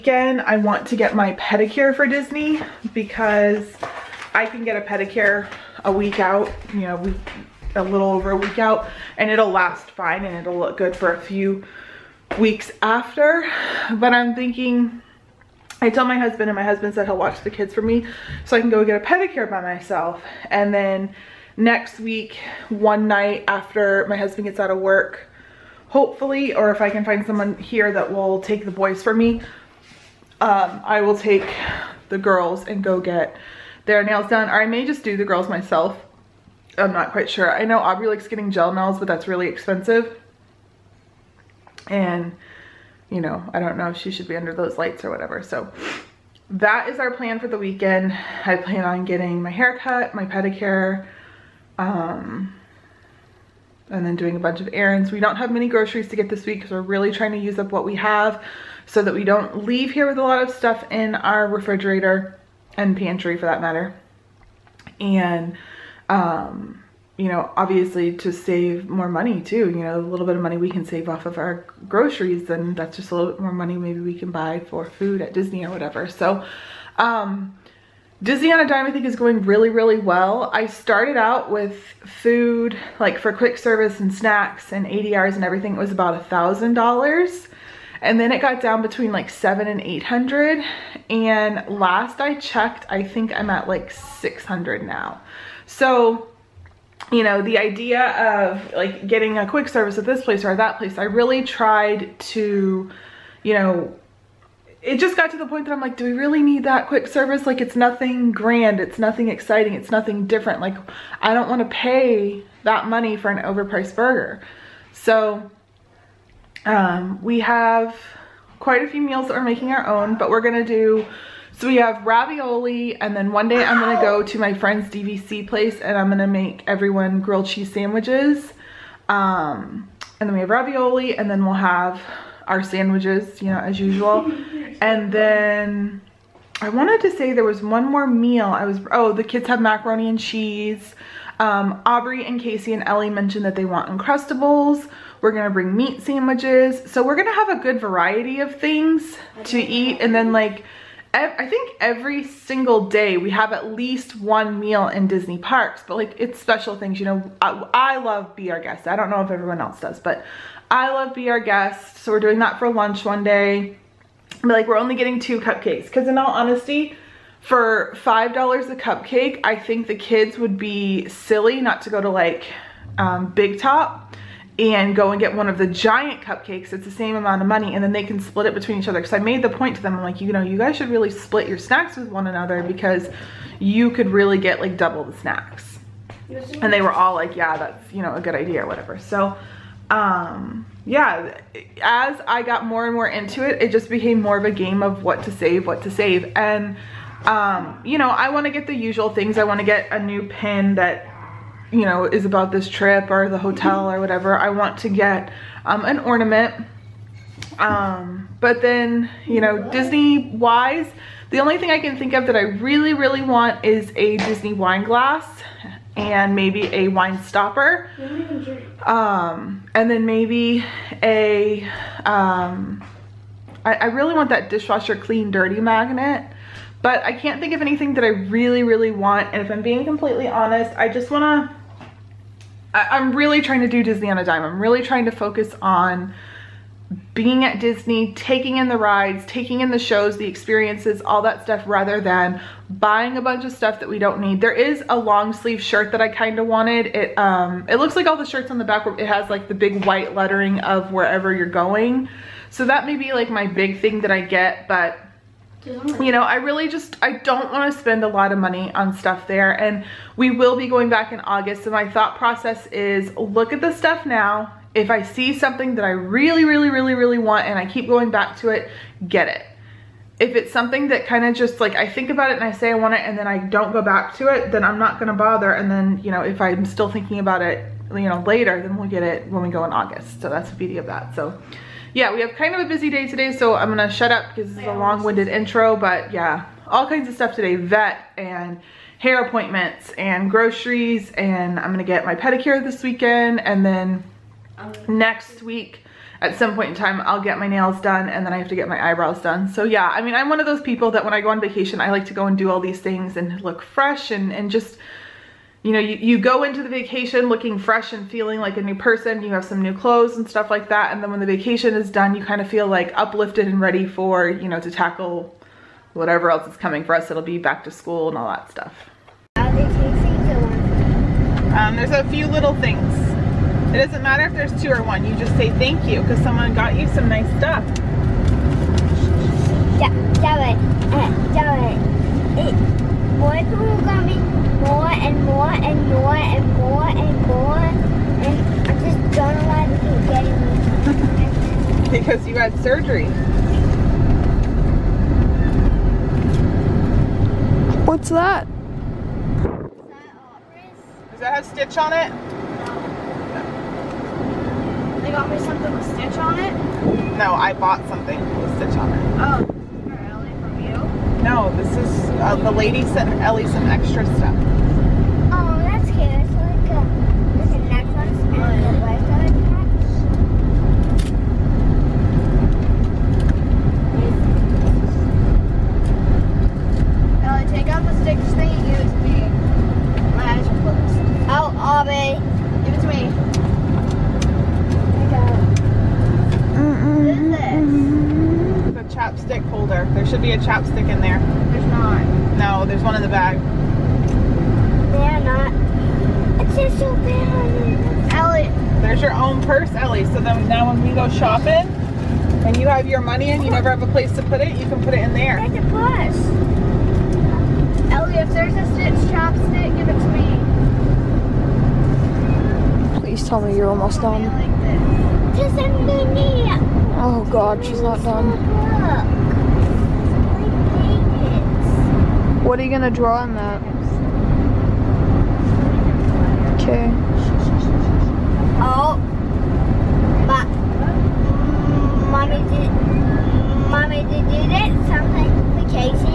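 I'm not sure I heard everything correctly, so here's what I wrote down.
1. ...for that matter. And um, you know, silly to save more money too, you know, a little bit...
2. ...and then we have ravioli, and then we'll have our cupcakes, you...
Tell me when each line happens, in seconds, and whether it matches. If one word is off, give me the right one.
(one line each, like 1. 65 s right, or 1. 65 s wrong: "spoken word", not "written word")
1. 63 s wrong: "obviously", not "silly"
2. 130 s wrong: "sandwiches", not "cupcakes".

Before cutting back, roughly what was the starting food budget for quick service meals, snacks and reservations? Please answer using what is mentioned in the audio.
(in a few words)
$1000.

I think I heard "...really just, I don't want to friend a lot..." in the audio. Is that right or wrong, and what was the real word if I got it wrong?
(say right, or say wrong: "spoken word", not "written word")
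wrong: "spend", not "friend".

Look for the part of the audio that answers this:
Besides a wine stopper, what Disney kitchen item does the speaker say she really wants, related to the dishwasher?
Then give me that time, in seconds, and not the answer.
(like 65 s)
224 s.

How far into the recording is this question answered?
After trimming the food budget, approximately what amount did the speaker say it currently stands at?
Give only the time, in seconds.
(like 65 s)
93 s.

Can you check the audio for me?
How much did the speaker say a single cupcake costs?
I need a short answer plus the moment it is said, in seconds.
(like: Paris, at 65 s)
$5, at 168 s.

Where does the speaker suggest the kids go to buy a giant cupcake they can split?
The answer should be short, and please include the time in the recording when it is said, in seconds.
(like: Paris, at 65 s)
Big Top, at 173 s.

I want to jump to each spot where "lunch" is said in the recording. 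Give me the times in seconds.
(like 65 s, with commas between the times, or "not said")
162 s.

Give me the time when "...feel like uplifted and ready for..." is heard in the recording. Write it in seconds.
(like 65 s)
312 s.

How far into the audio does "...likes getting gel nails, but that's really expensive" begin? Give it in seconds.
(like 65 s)
38 s.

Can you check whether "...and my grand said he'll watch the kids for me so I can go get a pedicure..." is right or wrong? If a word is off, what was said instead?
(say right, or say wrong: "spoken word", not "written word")
wrong: "husband", not "grand".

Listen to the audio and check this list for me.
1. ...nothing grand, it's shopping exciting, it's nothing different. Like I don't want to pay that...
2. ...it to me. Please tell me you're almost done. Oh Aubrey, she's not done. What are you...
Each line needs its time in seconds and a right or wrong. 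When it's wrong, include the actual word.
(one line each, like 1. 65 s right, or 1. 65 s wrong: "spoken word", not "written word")
1. 107 s wrong: "nothing", not "shopping"
2. 409 s wrong: "God", not "Aubrey".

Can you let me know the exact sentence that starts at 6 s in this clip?
You know, we a little over a week out and it'll last fine and it'll look good for a few weeks after.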